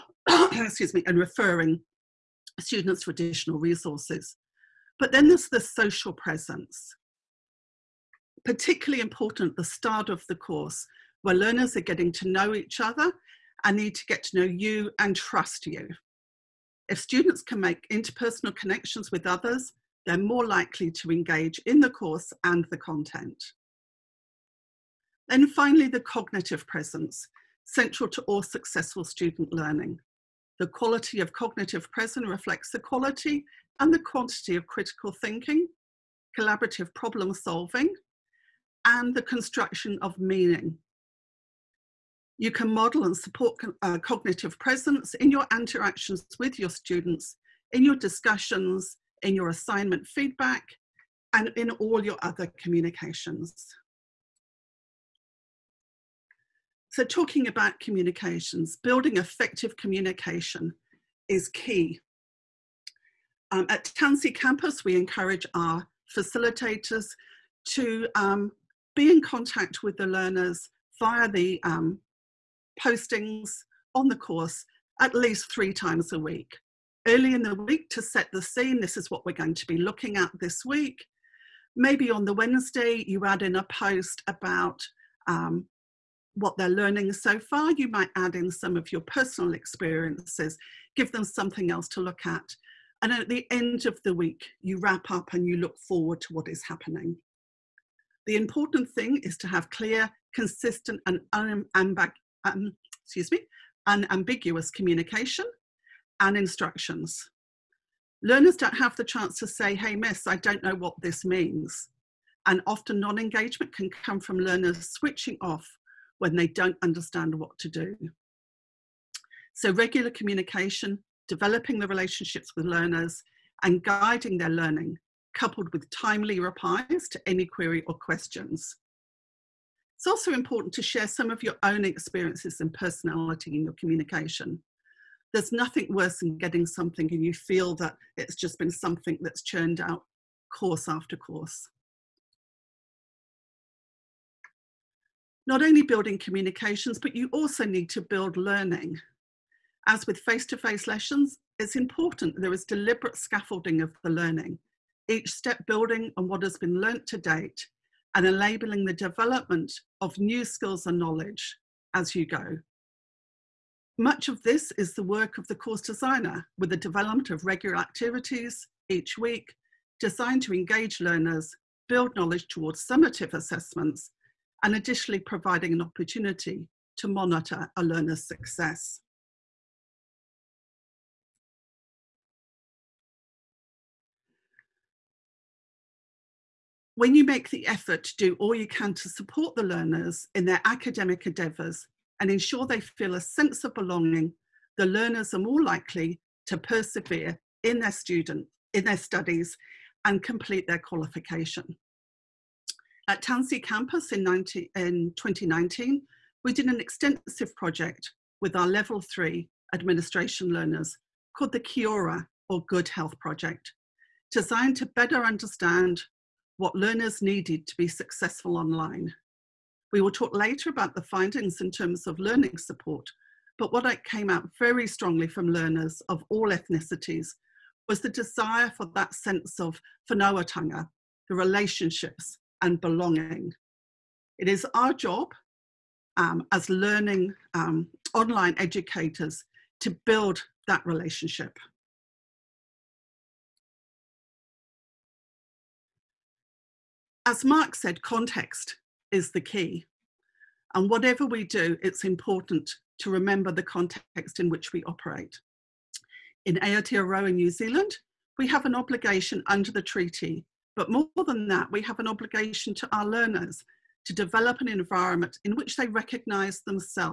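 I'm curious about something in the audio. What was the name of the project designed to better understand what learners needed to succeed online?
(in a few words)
Kiora or Good Health Project.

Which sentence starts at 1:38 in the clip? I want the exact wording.
The important thing is to have clear, consistent, and um, excuse me, unambiguous communication and instructions.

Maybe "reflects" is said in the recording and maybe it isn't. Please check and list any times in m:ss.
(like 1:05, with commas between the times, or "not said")
0:32.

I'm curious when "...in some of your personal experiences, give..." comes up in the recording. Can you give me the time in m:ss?
1:28.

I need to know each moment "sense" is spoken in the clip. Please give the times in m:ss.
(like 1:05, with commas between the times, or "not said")
3:13, 3:49.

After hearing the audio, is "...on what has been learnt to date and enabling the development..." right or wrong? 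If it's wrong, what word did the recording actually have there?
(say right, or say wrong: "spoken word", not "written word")
right.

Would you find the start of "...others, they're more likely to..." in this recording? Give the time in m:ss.
0:19.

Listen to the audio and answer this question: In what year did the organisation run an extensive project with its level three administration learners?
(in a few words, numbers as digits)
2019.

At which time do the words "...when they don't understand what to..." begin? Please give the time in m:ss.
1:56.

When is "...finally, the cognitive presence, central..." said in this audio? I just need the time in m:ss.
0:25.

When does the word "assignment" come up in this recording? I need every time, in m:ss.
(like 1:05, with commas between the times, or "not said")
0:49.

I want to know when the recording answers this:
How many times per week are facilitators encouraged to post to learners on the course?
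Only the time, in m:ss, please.
1:15.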